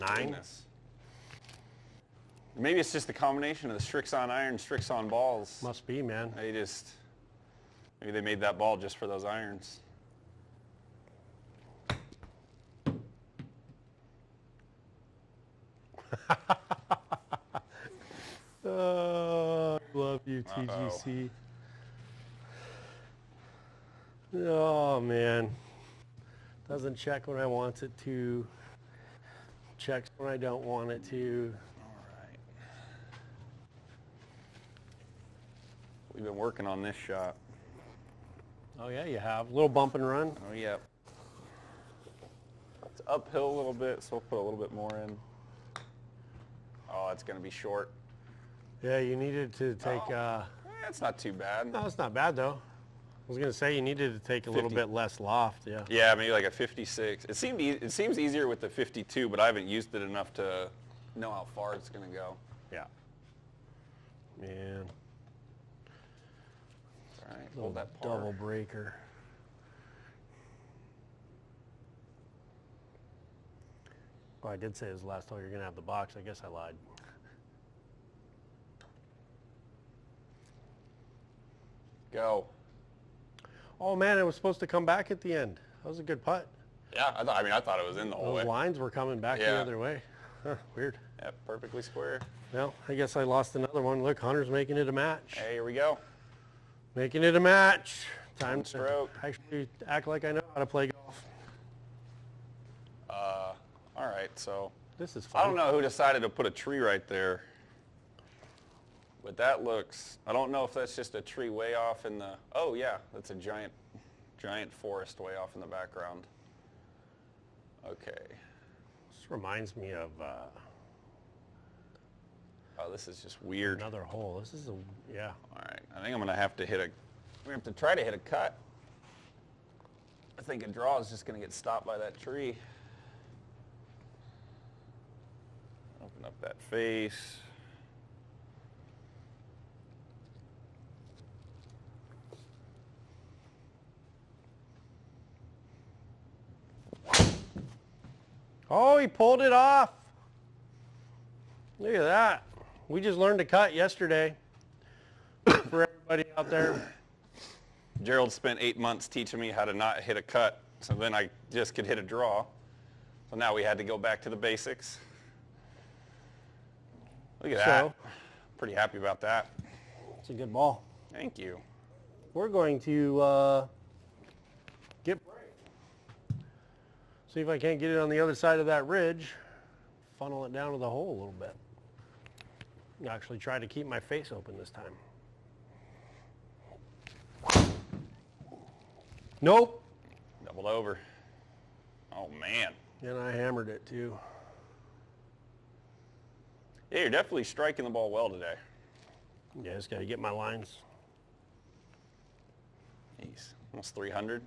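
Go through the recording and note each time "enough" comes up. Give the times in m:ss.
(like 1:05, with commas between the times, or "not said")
1:00.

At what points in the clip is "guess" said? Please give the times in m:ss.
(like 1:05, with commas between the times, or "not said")
1:16, 1:32.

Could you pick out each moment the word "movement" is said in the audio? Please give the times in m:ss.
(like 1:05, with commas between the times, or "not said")
not said.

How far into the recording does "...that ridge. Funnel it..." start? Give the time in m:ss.
2:58.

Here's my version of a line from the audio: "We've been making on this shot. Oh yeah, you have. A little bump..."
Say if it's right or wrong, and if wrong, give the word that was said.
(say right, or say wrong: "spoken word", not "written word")
wrong: "working", not "making".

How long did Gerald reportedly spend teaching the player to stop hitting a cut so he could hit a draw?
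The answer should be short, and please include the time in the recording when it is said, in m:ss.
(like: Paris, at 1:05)
Eight months, at 2:38.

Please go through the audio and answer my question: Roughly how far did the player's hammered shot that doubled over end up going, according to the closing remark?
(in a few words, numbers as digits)
Almost 300.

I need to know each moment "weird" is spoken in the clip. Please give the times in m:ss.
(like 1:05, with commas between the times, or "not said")
1:30, 2:03.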